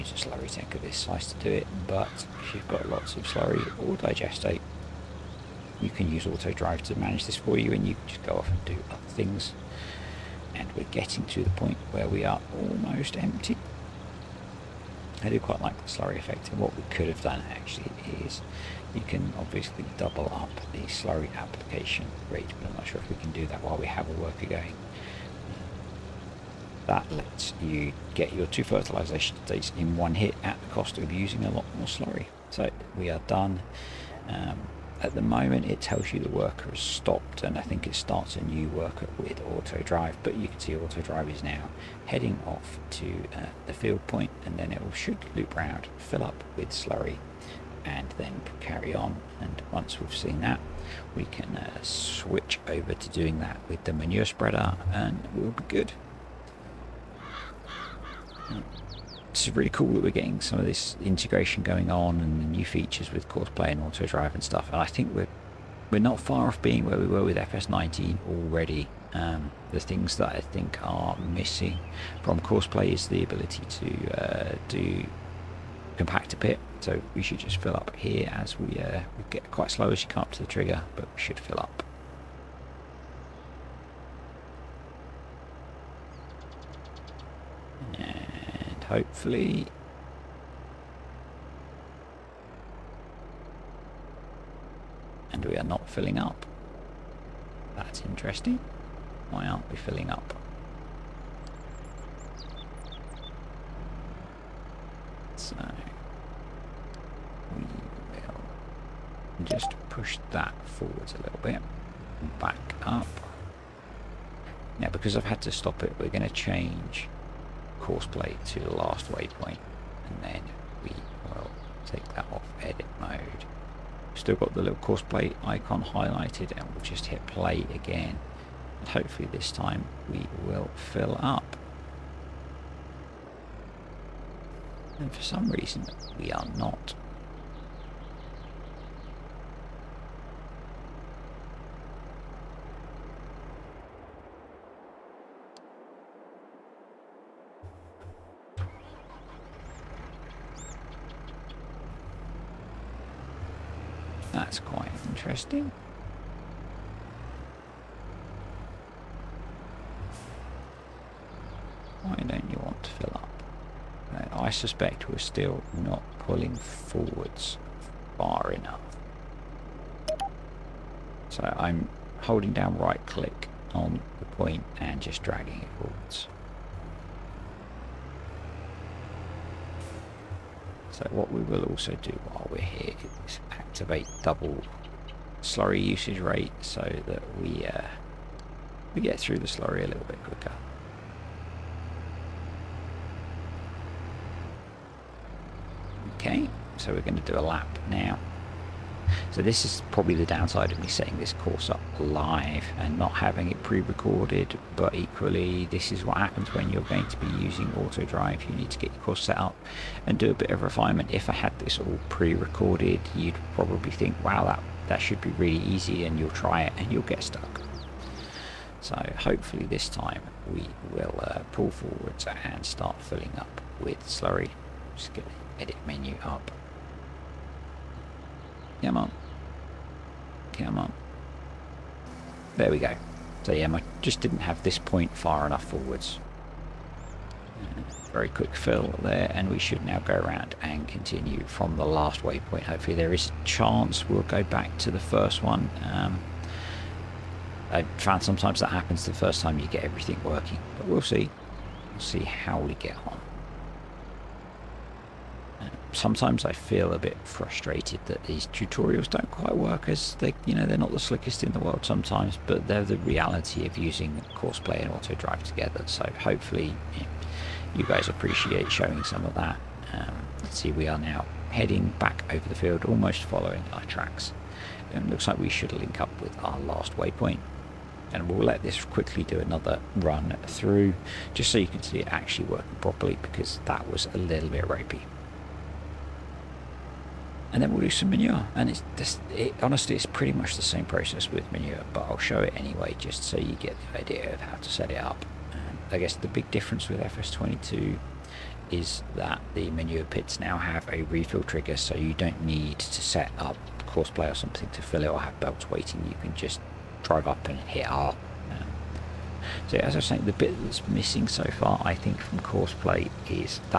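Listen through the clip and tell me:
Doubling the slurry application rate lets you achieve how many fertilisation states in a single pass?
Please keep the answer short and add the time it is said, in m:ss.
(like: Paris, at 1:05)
2, at 0:28.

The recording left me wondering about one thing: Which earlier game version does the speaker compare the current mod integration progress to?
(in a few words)
FS19.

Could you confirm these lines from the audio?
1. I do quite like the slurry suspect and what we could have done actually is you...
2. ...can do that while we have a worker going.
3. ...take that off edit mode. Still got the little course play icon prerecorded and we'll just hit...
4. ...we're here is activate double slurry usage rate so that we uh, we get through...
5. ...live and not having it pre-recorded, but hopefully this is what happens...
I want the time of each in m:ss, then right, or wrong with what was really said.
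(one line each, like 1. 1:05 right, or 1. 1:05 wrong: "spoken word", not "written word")
1. 0:15 wrong: "effect", not "suspect"
2. 0:23 right
3. 2:01 wrong: "highlighted", not "prerecorded"
4. 3:02 right
5. 3:21 wrong: "equally", not "hopefully".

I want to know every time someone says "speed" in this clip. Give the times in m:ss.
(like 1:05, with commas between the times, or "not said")
not said.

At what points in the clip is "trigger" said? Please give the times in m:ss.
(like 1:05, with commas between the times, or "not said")
1:20, 5:01.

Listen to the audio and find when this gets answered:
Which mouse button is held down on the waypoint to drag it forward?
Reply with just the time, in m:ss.
2:52.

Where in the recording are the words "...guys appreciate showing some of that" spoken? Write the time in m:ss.
4:27.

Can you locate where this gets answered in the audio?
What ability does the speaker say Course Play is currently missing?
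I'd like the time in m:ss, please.
1:15.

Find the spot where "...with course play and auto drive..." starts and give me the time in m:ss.
1:03.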